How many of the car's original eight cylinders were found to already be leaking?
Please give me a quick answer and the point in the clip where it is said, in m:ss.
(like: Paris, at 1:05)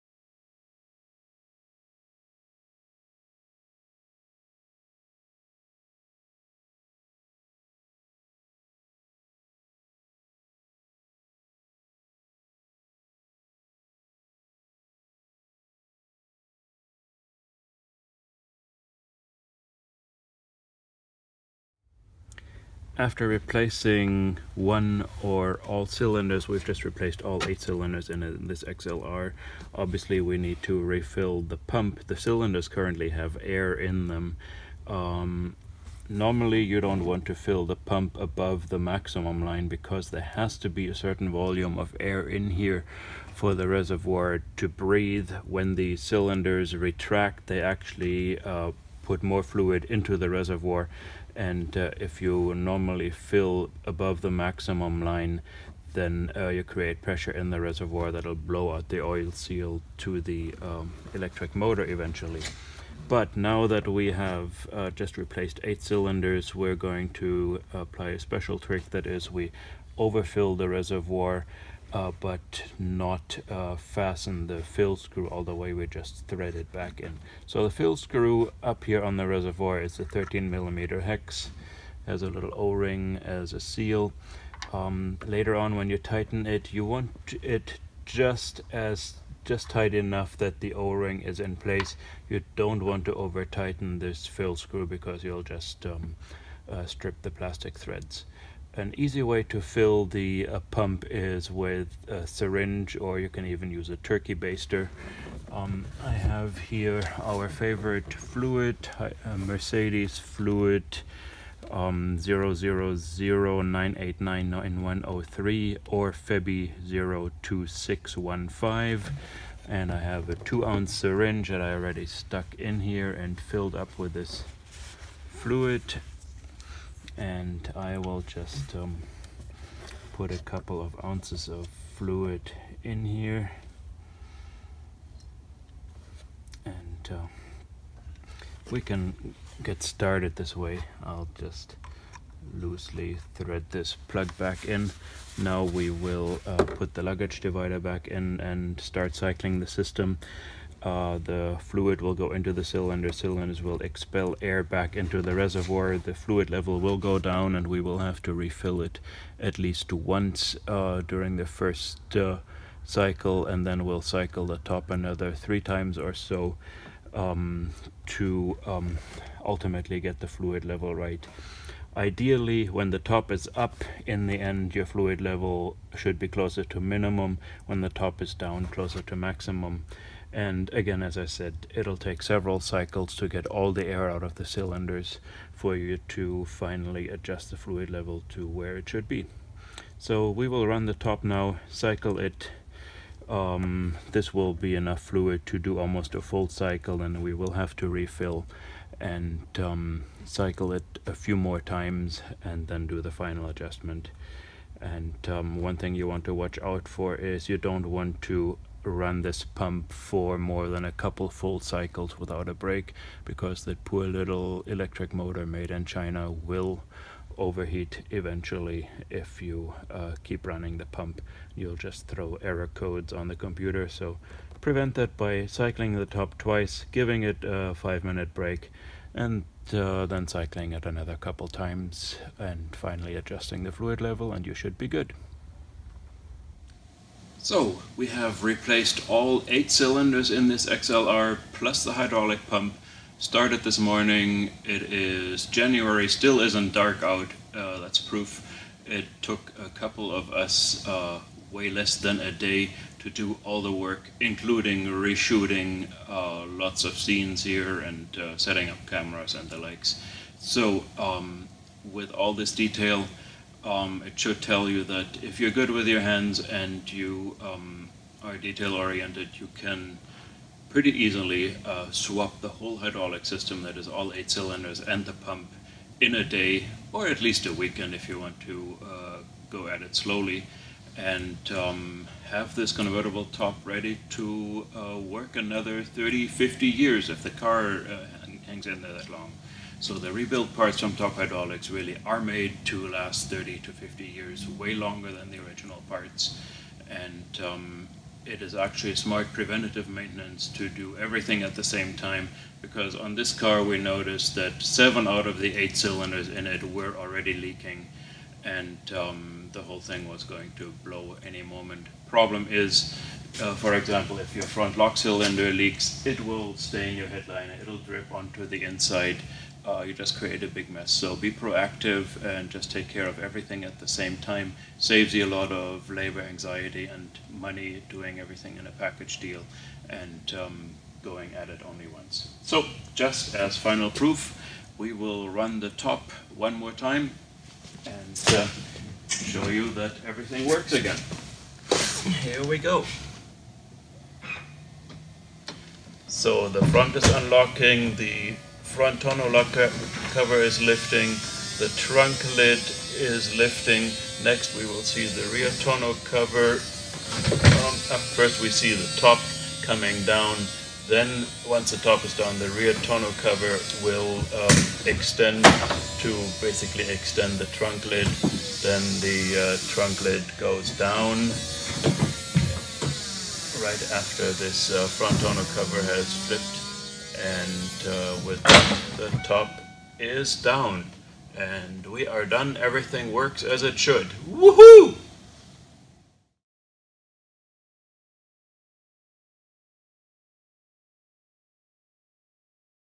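7, at 5:04.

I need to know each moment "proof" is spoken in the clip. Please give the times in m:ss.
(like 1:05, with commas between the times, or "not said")
4:07, 5:33.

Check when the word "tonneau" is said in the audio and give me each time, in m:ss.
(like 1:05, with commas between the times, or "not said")
5:55, 6:02, 6:15.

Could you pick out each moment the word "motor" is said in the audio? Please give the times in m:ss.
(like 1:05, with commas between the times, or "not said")
1:01, 3:35.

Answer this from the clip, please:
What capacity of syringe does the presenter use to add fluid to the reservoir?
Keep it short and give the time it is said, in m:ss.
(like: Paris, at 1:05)
two ounce, at 2:00.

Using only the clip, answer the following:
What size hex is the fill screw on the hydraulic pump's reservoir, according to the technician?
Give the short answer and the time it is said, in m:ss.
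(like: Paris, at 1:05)
13 millimeter, at 1:20.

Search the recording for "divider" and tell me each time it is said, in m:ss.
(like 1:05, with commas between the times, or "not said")
2:27.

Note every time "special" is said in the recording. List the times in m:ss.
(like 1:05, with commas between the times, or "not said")
1:08.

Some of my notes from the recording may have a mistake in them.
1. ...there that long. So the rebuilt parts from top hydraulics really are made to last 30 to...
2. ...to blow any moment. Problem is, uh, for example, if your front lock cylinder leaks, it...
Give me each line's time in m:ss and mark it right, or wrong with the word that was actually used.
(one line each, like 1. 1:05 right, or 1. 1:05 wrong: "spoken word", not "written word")
1. 4:48 right
2. 5:10 right.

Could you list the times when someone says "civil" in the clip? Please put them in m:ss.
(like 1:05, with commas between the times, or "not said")
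not said.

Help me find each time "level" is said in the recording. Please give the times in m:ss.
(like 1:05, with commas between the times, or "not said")
2:36, 2:50, 2:55, 3:07, 3:54.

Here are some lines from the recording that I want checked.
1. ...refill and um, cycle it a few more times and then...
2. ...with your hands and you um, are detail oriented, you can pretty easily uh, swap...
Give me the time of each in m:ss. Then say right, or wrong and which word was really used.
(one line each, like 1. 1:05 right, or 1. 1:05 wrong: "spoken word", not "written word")
1. 3:17 right
2. 4:25 right.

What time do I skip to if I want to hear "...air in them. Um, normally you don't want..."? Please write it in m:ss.
0:33.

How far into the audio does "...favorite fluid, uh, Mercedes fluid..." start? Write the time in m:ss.
1:47.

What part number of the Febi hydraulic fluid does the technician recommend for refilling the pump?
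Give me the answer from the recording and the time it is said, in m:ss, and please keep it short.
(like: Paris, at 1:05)
02615, at 1:57.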